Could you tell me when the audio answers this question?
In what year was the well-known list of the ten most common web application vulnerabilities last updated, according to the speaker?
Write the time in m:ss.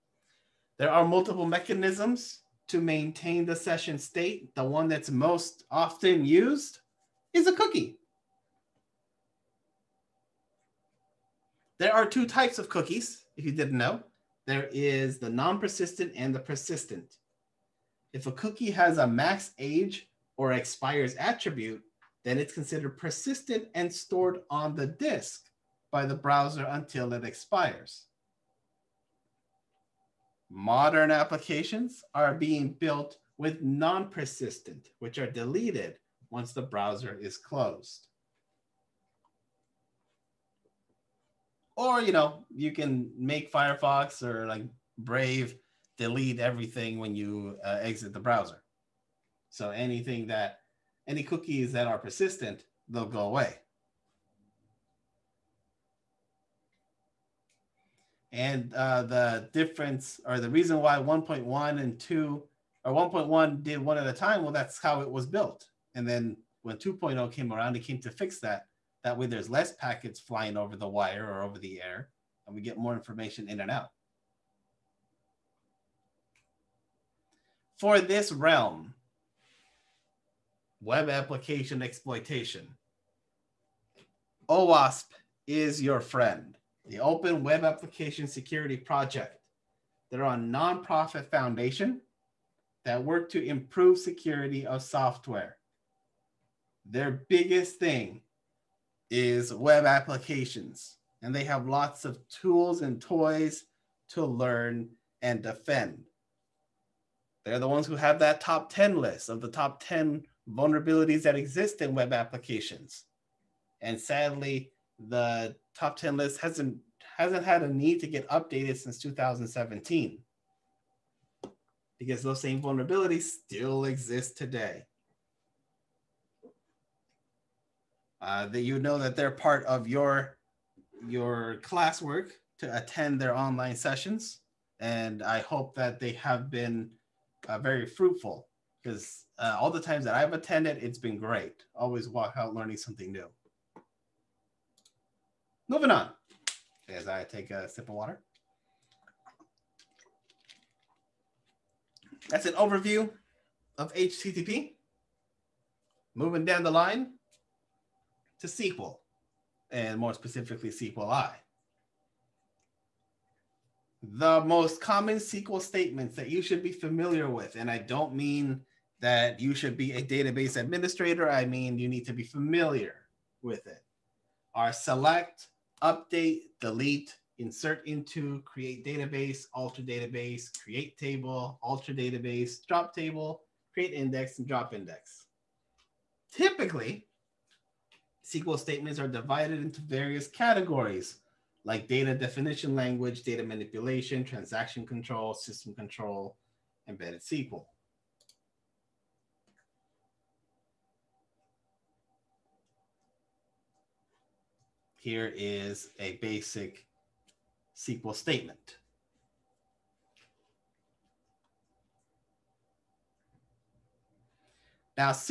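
1:58.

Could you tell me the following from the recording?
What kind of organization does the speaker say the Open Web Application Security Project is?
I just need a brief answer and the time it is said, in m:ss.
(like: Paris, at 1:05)
Nonprofit foundation, at 1:30.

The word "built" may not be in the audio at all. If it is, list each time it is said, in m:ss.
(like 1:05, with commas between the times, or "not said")
0:32, 1:05.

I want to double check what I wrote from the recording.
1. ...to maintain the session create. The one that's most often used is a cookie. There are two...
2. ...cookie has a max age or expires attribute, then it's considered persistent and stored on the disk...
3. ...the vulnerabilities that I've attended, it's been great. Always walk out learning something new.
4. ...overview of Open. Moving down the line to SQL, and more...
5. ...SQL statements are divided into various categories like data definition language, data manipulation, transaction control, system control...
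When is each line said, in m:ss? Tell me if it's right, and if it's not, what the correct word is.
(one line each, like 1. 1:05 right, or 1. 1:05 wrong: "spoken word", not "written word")
1. 0:02 wrong: "state", not "create"
2. 0:18 right
3. 2:19 wrong: "times", not "vulnerabilities"
4. 2:32 wrong: "HTTP", not "Open"
5. 3:08 right.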